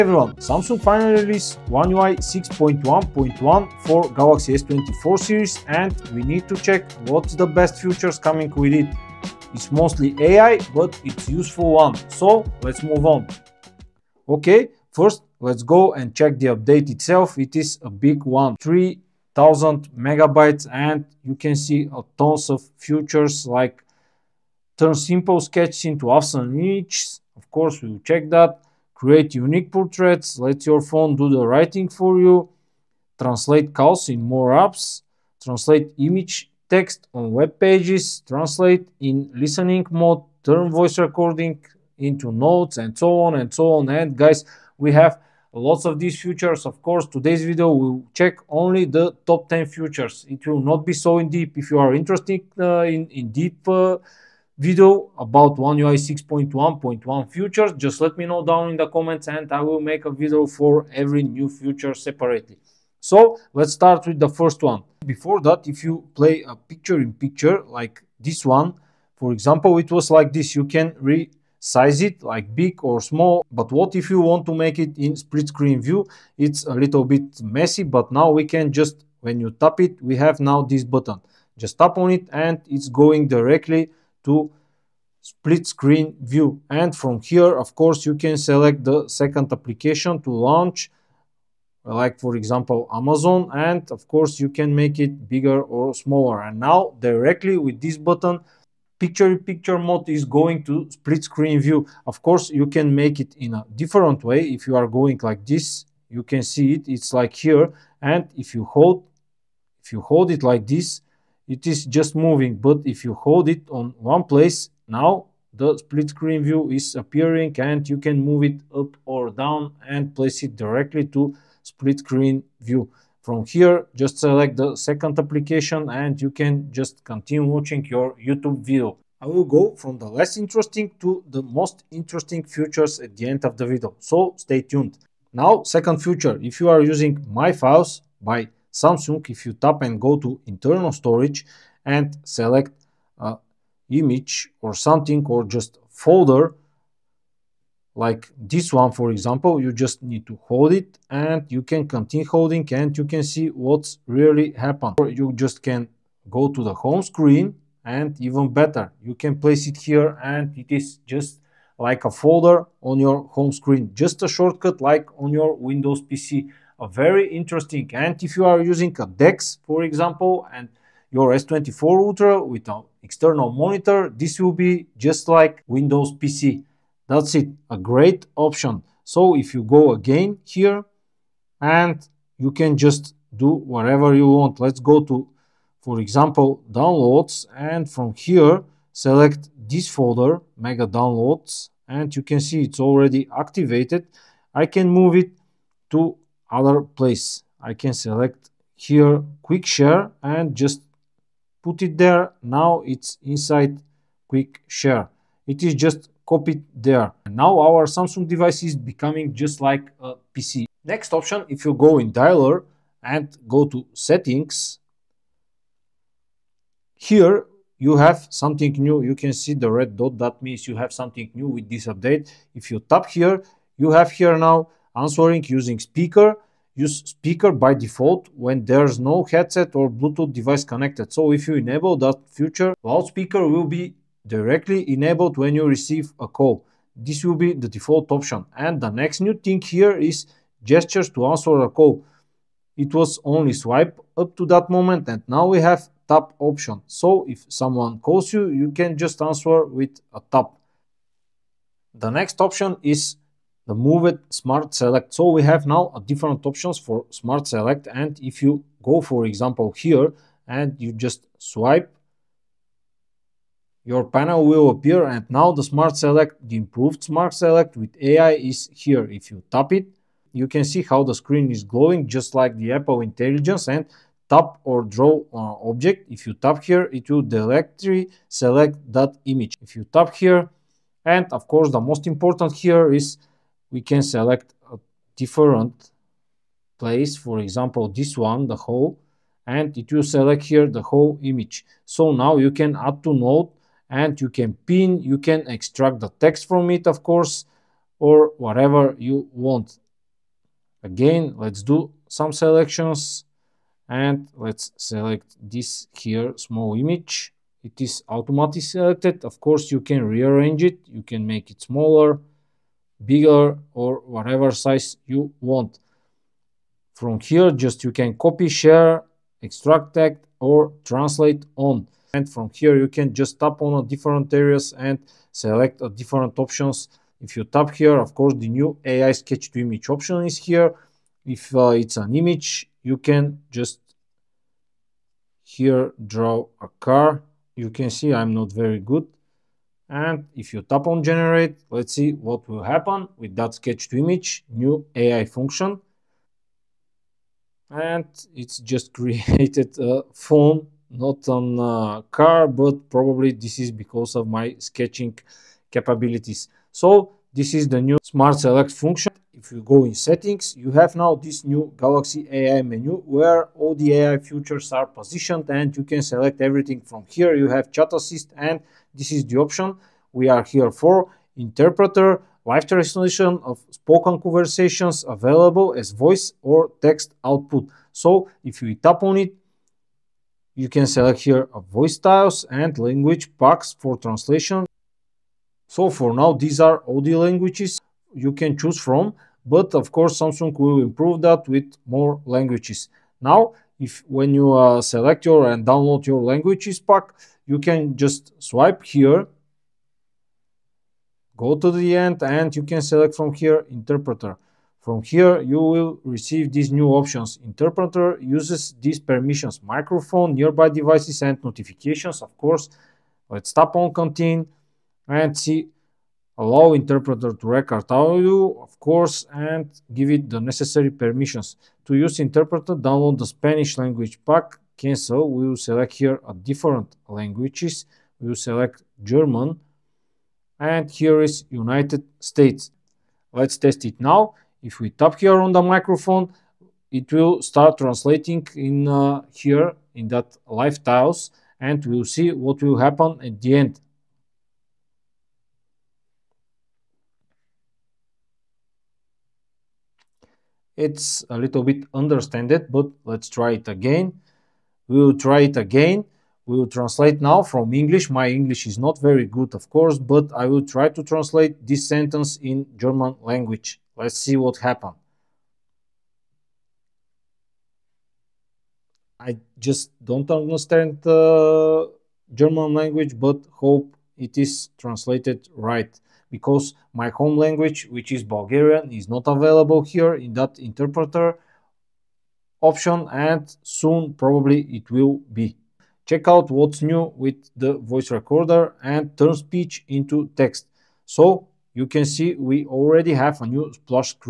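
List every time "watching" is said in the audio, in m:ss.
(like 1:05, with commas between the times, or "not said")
2:07.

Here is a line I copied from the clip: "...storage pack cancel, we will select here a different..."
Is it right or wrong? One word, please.
wrong.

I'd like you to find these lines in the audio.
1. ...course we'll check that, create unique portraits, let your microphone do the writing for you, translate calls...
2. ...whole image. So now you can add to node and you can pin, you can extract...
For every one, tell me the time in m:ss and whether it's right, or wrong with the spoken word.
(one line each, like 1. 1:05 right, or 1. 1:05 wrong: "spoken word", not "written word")
1. 0:27 wrong: "phone", not "microphone"
2. 4:50 right.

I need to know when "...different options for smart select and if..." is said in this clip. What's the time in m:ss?
4:16.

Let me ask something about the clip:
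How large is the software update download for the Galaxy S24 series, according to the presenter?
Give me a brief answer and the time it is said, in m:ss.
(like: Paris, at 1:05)
3000 megabytes, at 0:18.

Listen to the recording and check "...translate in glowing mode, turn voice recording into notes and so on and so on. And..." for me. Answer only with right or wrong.
wrong.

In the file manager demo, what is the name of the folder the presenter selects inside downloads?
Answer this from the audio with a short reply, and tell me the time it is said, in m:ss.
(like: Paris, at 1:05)
mega downloads, at 3:10.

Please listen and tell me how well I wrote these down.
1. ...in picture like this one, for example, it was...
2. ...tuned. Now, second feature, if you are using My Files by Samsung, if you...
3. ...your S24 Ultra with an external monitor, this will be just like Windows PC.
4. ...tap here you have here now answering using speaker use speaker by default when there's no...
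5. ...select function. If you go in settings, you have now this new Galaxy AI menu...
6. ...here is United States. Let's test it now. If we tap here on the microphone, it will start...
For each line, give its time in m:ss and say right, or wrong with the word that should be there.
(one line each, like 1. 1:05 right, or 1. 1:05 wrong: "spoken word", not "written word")
1. 1:06 right
2. 2:14 right
3. 2:51 right
4. 3:42 right
5. 5:58 right
6. 7:10 right.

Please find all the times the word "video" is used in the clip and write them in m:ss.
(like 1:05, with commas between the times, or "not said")
0:47, 0:54, 1:00, 2:08, 2:13.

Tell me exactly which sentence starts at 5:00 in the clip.
Again, let's do some selections and let's select this here small image.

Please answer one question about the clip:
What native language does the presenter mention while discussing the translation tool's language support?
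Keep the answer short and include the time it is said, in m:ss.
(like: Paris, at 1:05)
Bulgarian, at 7:58.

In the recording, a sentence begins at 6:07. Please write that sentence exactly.
You have chat assist and this is the option we are here for.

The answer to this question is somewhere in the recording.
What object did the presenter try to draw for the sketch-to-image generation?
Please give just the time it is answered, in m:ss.
5:36.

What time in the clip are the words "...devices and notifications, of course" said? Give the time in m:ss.
6:50.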